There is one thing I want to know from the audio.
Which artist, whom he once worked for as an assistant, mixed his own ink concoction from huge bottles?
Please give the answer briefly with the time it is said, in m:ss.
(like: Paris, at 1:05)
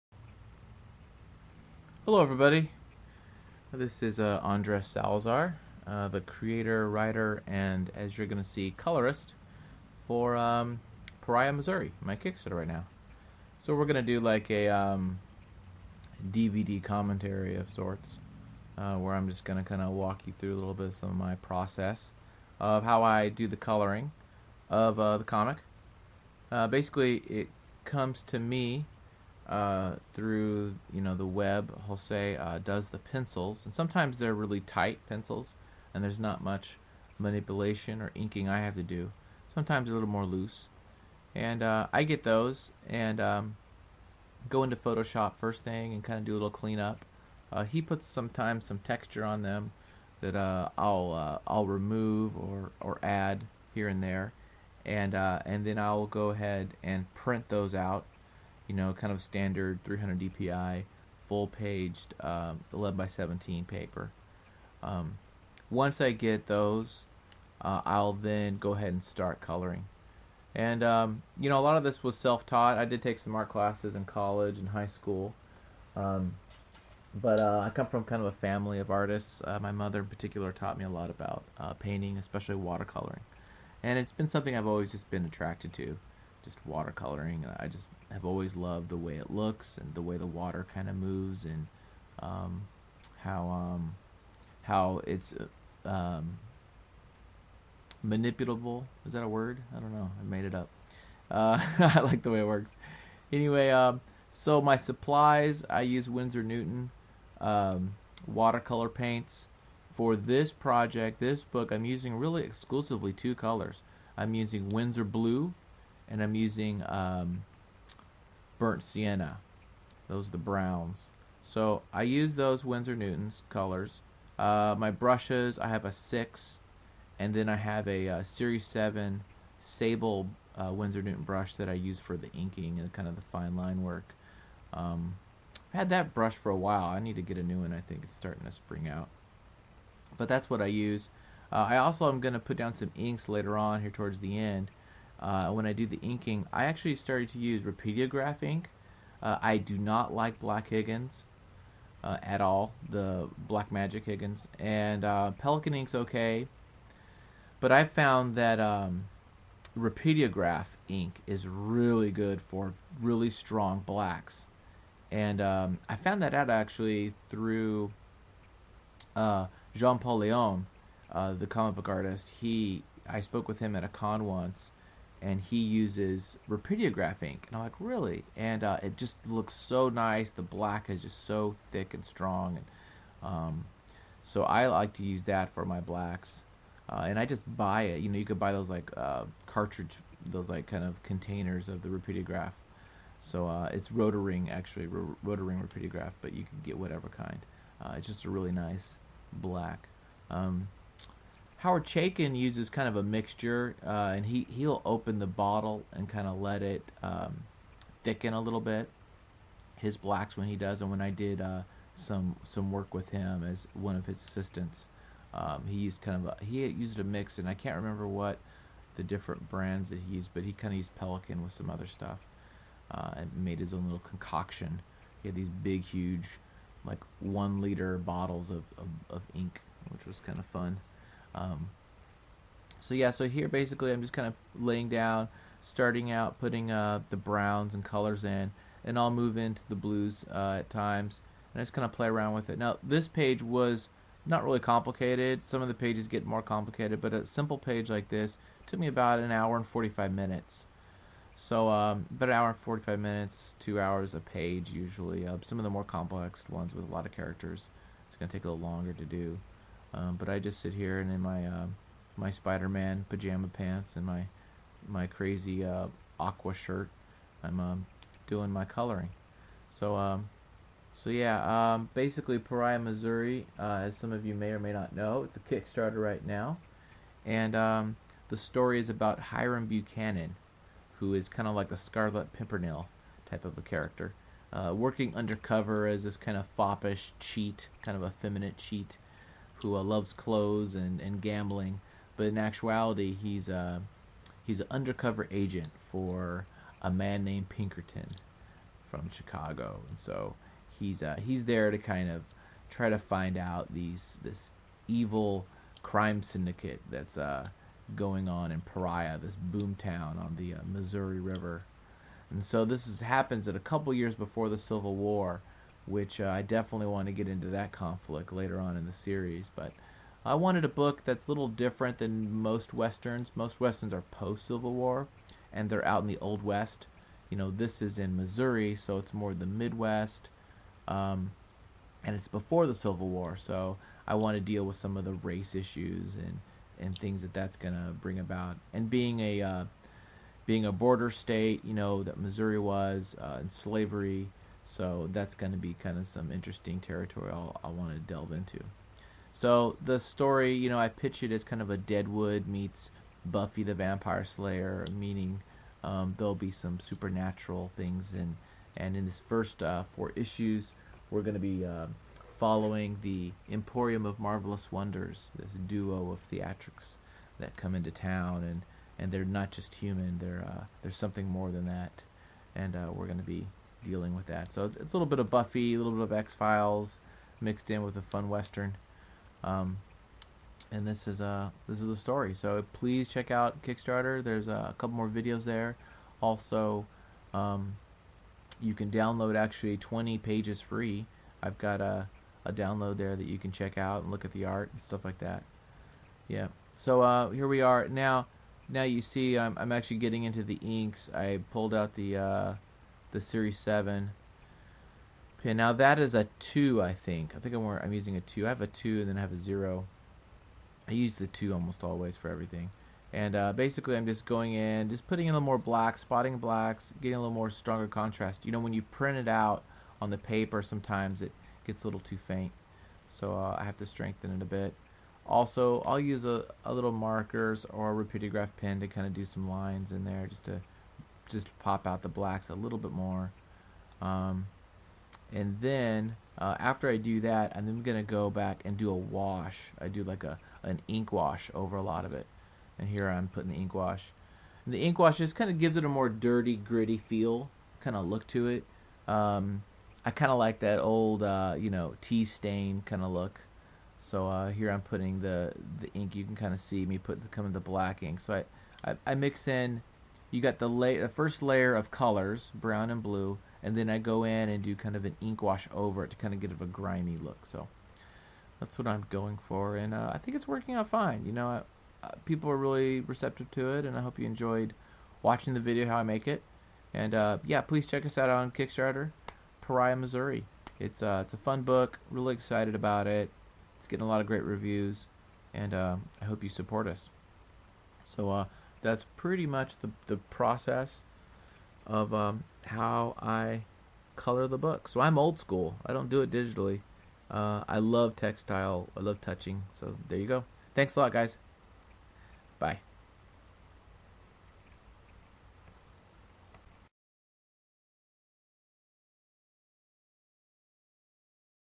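Howard Chaykin, at 3:21.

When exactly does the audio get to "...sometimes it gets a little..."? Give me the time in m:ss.
7:00.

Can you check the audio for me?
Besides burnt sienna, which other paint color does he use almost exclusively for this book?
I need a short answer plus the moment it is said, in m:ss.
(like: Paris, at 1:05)
Winsor Blue, at 1:54.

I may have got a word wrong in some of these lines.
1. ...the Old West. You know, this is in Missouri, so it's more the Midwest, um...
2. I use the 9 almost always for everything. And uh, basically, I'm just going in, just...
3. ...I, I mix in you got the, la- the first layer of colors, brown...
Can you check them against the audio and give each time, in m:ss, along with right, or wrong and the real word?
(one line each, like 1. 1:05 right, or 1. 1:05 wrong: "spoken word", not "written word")
1. 5:26 right
2. 6:50 wrong: "2", not "9"
3. 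7:38 right.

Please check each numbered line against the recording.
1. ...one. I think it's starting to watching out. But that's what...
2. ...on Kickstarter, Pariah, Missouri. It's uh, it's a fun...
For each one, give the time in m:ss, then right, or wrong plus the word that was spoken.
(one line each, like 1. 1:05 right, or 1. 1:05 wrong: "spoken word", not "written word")
1. 2:17 wrong: "spring", not "watching"
2. 7:58 right.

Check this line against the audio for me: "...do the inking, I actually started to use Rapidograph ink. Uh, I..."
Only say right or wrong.
right.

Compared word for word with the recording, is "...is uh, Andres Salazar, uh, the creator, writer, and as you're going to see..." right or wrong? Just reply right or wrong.
right.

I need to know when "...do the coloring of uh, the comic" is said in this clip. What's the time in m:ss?
0:23.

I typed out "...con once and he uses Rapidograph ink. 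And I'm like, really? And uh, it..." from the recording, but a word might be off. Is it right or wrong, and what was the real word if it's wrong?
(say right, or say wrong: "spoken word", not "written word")
right.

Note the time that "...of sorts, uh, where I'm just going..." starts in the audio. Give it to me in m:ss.
0:17.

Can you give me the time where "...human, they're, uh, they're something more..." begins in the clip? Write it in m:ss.
6:09.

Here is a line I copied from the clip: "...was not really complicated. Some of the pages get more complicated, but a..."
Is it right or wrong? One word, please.
right.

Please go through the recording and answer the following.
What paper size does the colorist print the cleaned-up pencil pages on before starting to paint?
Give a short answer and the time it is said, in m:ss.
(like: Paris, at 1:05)
11 by 17, at 1:02.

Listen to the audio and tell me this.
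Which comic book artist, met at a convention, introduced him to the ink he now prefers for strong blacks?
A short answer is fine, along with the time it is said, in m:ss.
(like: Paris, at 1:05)
John Paul Leon, at 2:49.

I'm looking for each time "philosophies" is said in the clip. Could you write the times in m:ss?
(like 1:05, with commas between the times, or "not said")
not said.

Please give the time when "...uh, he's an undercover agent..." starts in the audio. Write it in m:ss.
4:53.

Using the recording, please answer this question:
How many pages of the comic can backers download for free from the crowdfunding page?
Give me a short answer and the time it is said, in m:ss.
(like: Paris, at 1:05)
20, at 6:29.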